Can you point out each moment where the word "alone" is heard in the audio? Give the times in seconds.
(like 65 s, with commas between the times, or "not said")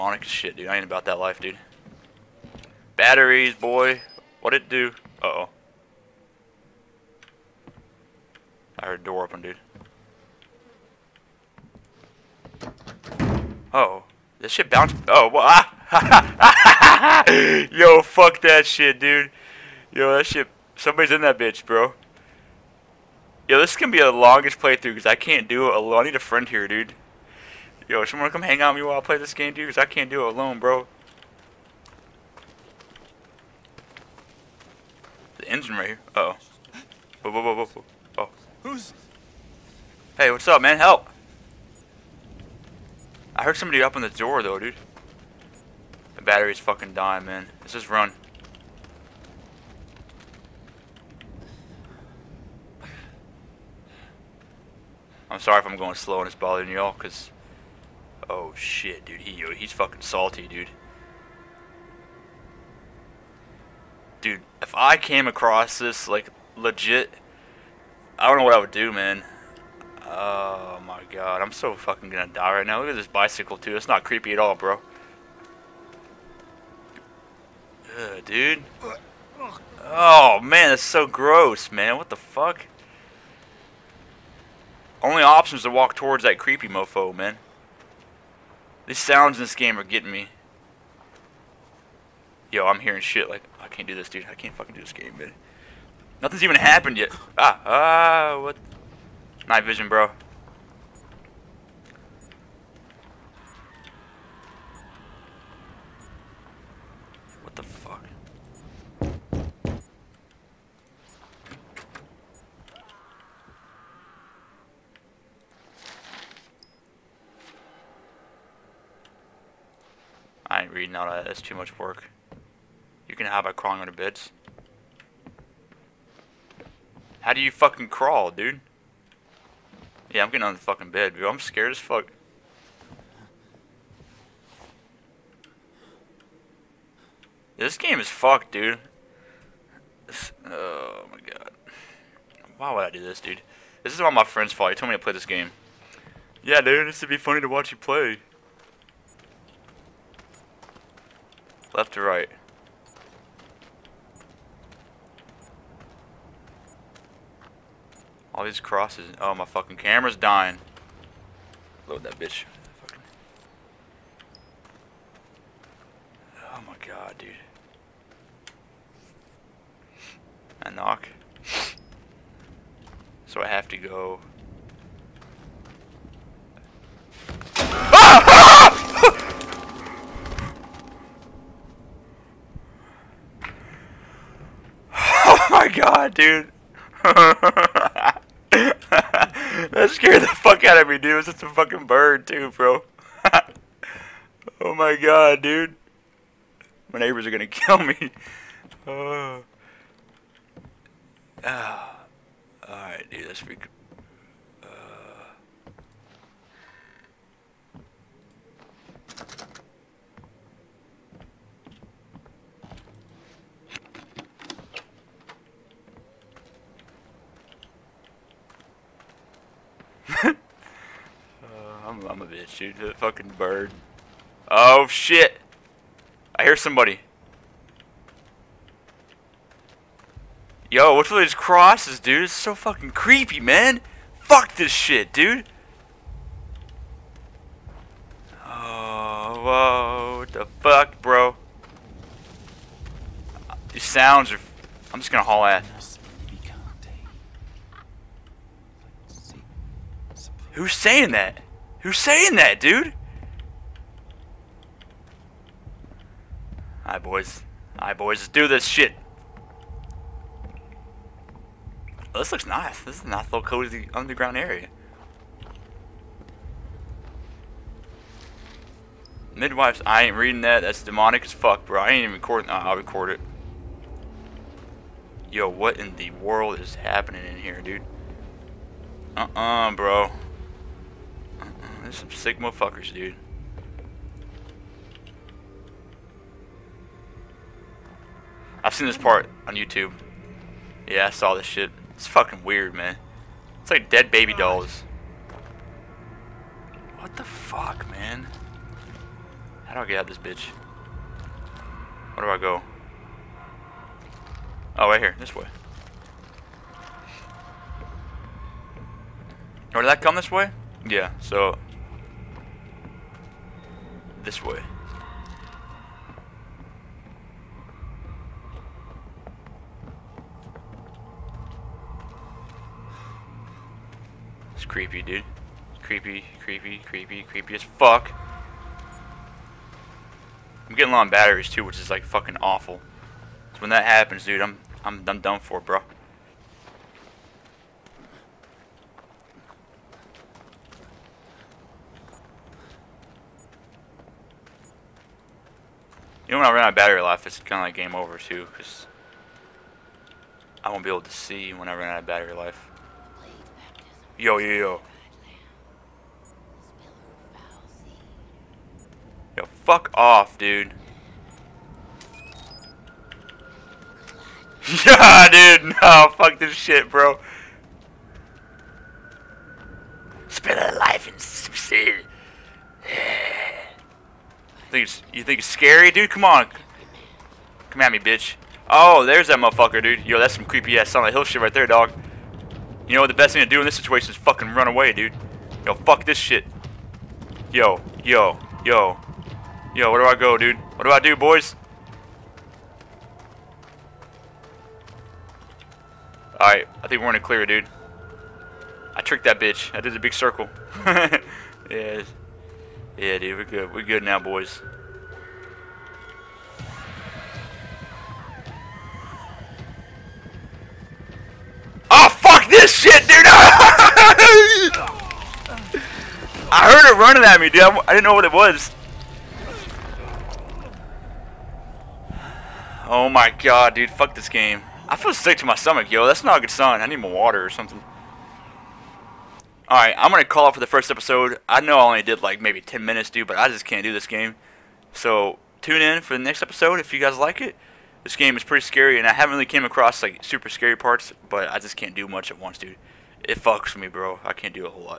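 25 s, 30 s.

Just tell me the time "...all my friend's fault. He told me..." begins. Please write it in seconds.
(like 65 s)
144 s.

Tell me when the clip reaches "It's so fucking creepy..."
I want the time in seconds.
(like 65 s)
232 s.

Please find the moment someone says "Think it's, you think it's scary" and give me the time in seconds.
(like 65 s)
374 s.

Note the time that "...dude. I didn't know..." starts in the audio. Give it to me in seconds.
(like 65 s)
417 s.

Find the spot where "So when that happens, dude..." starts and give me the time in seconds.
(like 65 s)
333 s.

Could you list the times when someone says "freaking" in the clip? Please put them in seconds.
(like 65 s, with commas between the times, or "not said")
203 s.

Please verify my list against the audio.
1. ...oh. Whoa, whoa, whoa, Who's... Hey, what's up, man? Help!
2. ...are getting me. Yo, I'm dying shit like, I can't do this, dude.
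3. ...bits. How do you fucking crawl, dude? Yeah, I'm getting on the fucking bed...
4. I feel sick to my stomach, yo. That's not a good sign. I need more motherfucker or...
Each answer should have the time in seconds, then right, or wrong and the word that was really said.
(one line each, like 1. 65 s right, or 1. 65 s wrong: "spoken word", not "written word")
1. 36 s right
2. 89 s wrong: "hearing", not "dying"
3. 123 s right
4. 424 s wrong: "water", not "motherfucker".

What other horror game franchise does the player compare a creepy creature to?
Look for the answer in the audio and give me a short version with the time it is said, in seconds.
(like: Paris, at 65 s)
Silent Hill, at 380 s.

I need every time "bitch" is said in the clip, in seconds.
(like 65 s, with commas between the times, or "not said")
21 s, 162 s, 222 s, 300 s, 377 s, 399 s.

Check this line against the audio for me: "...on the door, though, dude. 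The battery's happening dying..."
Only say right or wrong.
wrong.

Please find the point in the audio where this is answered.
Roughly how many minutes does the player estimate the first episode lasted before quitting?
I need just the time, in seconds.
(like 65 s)
432 s.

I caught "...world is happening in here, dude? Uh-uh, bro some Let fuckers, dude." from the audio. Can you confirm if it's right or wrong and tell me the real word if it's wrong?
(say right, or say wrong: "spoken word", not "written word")
wrong: "Sigma", not "Let".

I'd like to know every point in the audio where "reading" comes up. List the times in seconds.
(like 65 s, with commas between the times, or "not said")
120 s, 270 s.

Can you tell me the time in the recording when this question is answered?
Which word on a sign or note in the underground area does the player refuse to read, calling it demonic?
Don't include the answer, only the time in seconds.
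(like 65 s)
269 s.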